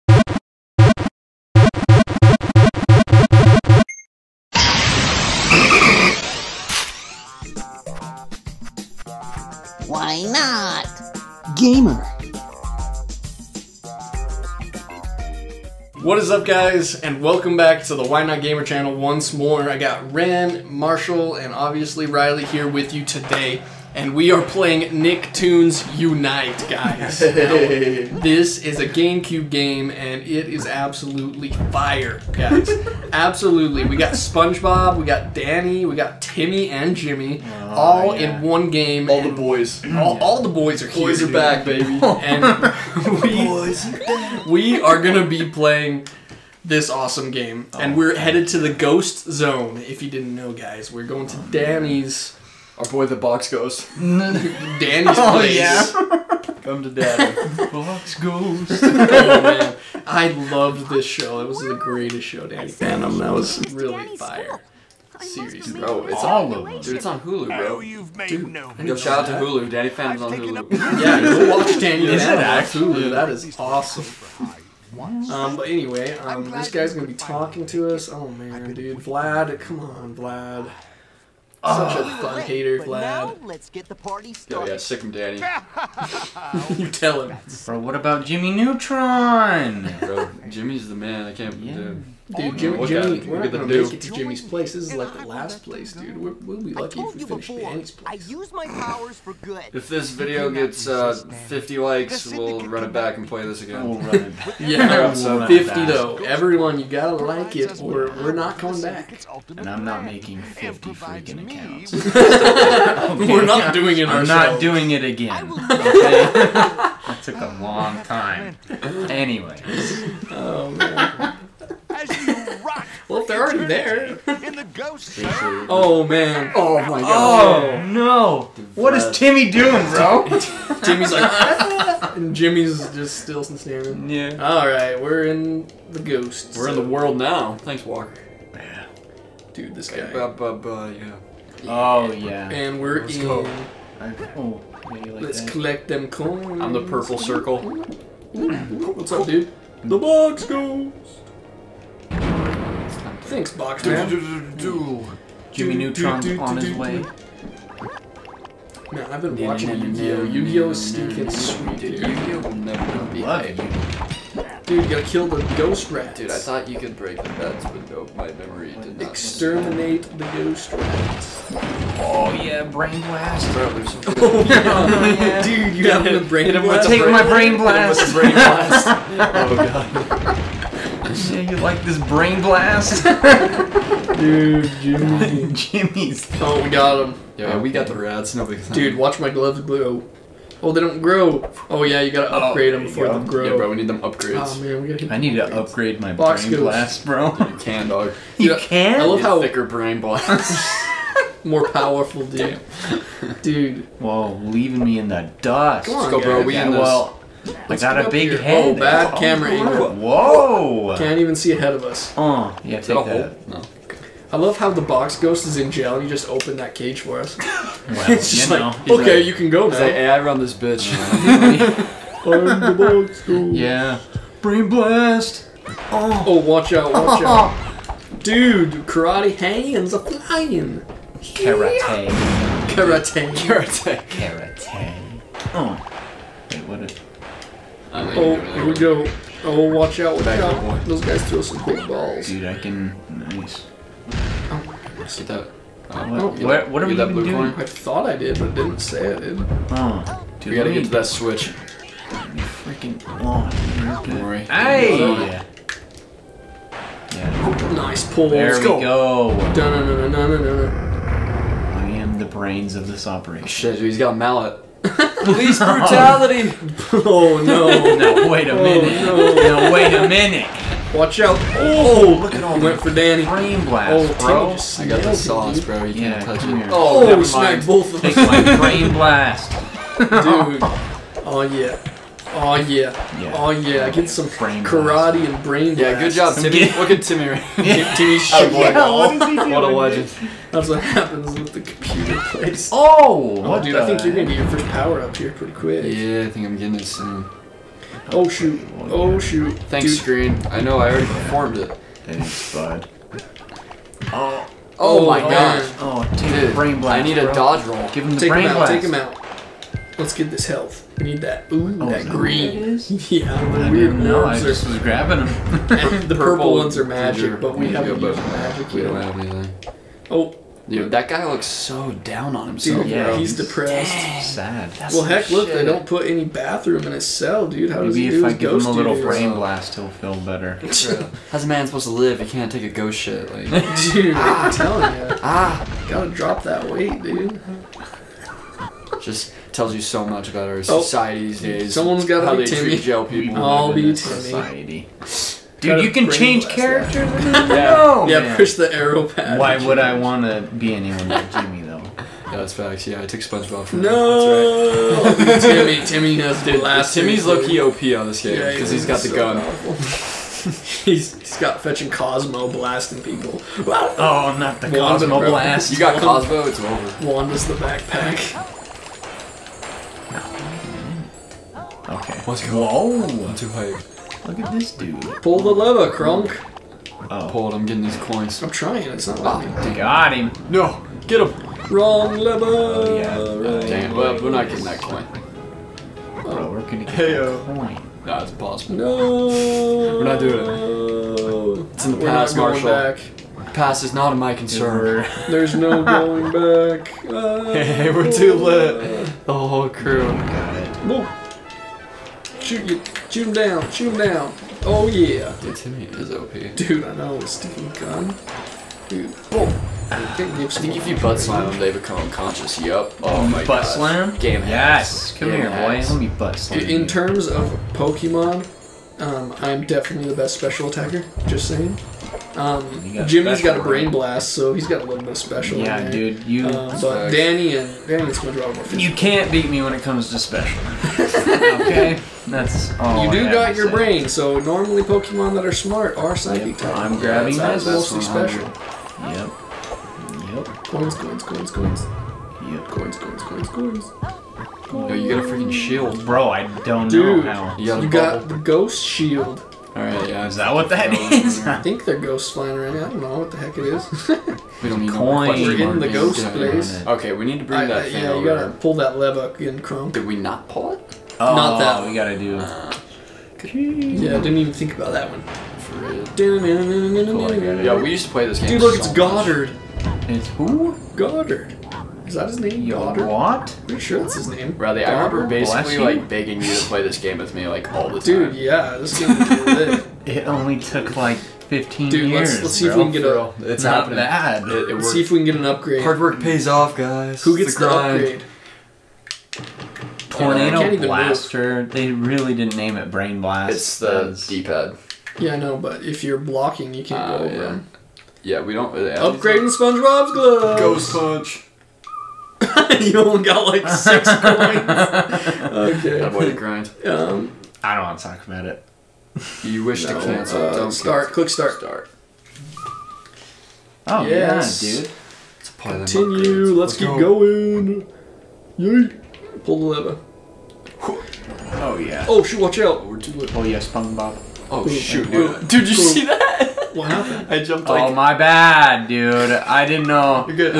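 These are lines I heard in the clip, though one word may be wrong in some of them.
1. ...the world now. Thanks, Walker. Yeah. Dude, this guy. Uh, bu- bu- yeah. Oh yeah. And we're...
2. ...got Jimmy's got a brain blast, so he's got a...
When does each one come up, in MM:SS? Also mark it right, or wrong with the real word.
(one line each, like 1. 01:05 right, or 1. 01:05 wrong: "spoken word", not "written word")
1. 02:16 right
2. 07:02 right.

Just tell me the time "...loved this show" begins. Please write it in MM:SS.
01:00.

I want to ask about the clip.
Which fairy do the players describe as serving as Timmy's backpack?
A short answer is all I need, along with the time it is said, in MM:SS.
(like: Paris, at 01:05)
Wanda, at 06:07.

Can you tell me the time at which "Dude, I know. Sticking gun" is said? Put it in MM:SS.
06:46.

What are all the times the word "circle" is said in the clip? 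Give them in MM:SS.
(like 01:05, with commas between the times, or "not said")
02:27.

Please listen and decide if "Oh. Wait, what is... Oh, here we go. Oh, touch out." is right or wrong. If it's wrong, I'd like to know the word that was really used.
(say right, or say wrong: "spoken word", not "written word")
wrong: "watch", not "touch".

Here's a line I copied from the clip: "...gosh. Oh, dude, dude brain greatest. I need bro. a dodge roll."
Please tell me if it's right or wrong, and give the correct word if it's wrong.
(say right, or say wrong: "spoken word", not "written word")
wrong: "blast", not "greatest".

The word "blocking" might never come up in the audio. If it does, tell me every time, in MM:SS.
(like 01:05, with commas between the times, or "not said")
08:16.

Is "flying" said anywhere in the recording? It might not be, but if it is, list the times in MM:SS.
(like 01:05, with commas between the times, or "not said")
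03:49, 07:32.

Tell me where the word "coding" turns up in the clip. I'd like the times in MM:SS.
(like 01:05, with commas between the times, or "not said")
not said.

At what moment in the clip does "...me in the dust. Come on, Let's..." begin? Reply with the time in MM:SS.
03:24.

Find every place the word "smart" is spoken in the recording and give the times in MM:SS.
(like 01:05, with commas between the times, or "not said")
07:15.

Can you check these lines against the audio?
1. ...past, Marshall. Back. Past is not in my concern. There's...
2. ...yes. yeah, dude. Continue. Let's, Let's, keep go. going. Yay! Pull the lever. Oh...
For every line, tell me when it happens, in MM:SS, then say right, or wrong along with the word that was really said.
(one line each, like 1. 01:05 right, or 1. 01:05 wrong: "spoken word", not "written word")
1. 06:32 right
2. 08:34 right.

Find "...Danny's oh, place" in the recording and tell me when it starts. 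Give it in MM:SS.
00:53.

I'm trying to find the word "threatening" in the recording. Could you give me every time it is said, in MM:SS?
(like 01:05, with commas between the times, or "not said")
not said.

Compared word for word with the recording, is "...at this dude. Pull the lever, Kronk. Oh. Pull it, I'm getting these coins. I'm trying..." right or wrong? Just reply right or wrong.
right.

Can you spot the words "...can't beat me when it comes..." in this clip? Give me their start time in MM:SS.
07:08.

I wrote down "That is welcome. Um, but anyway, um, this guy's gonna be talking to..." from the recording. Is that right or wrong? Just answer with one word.
wrong.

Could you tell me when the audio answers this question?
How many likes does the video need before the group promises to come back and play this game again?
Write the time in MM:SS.
01:40.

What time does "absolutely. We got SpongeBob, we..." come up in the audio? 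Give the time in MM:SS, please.
00:33.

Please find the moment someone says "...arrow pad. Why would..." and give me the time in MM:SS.
05:48.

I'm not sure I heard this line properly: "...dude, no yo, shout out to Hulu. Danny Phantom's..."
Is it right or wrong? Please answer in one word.
right.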